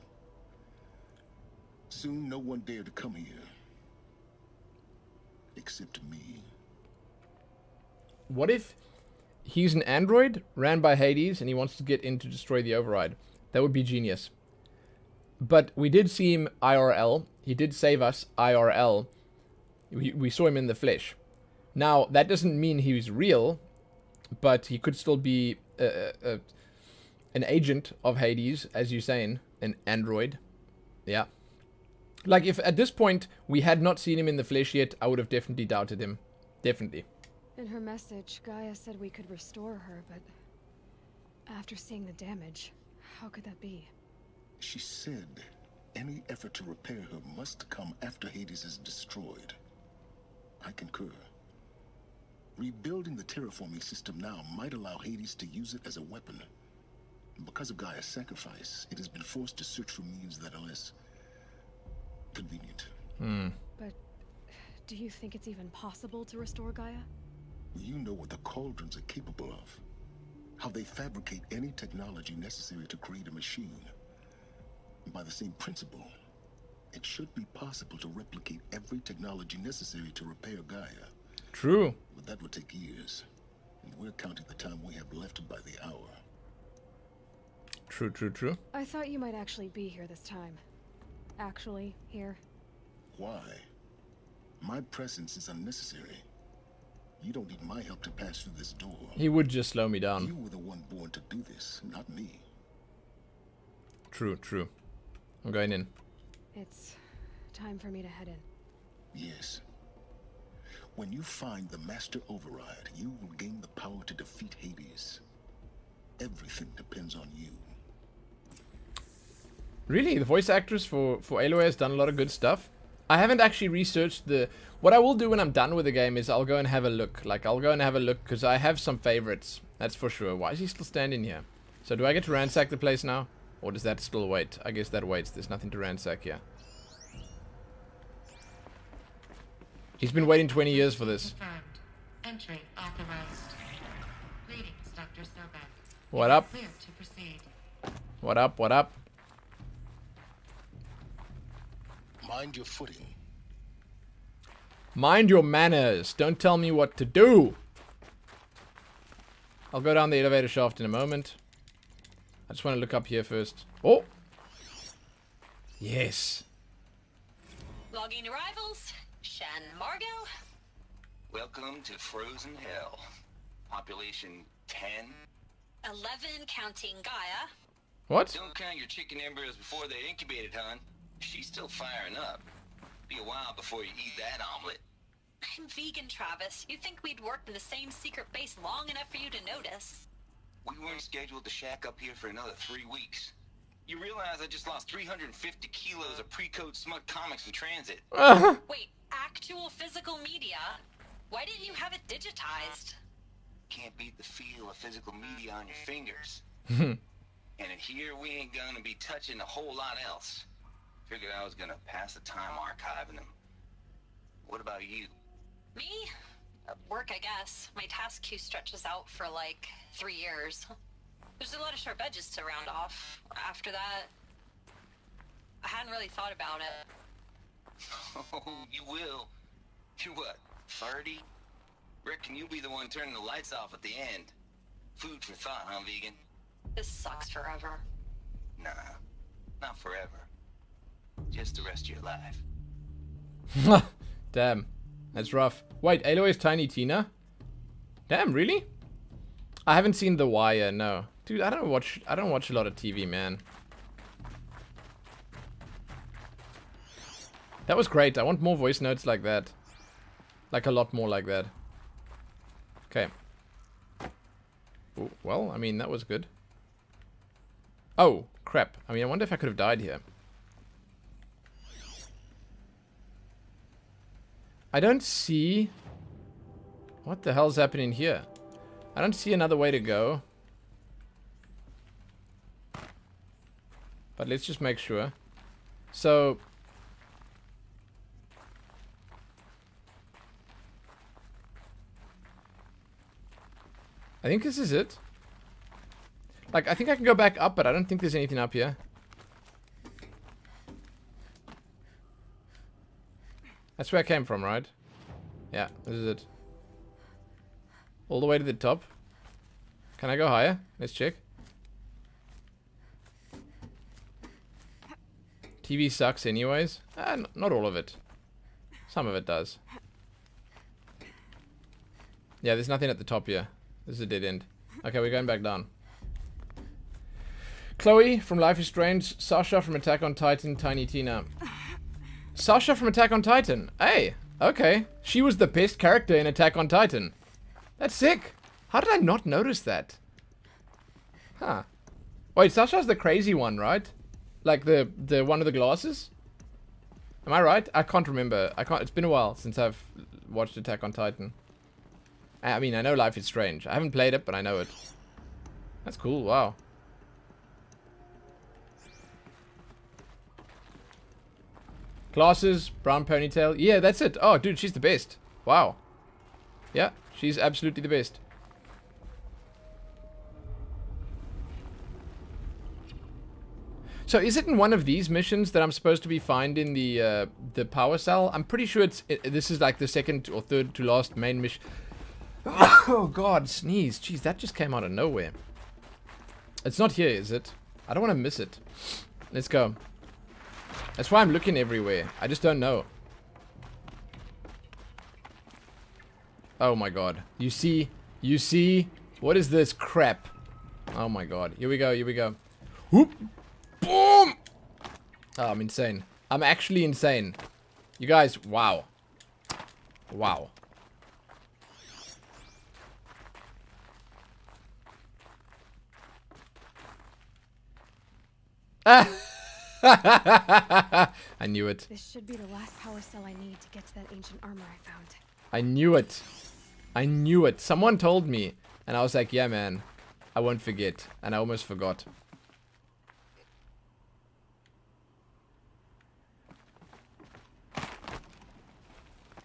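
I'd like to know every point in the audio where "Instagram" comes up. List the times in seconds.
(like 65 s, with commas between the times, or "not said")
not said.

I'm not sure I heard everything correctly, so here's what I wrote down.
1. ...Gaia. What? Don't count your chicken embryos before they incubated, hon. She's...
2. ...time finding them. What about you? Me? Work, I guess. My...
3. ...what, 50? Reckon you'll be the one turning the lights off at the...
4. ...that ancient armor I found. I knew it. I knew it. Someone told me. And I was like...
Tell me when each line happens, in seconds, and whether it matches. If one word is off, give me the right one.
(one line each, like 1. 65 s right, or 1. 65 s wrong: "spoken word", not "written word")
1. 177 s right
2. 212 s wrong: "archiving", not "finding"
3. 230 s wrong: "30", not "50"
4. 423 s right.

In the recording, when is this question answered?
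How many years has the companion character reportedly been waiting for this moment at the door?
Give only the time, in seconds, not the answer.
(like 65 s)
140 s.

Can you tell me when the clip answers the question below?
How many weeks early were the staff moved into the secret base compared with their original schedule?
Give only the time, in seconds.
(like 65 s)
192 s.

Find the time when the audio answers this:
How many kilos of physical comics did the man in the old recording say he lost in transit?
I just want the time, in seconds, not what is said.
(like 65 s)
194 s.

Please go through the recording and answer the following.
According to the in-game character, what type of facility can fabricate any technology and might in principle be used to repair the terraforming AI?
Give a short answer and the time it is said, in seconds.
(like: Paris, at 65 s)
Cauldrons, at 68 s.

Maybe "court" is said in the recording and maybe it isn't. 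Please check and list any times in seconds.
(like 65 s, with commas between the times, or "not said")
not said.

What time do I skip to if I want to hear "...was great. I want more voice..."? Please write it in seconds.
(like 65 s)
257 s.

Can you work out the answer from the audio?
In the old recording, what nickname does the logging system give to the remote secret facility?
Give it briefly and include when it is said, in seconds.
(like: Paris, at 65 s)
Frozen Hell, at 171 s.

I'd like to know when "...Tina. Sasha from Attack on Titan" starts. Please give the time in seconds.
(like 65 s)
330 s.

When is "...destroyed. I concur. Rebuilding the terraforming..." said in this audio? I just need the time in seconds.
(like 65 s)
48 s.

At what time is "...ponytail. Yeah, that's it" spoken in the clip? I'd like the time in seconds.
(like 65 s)
363 s.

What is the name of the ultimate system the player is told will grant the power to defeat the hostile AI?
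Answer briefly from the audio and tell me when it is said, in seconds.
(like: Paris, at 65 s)
Master Override, at 111 s.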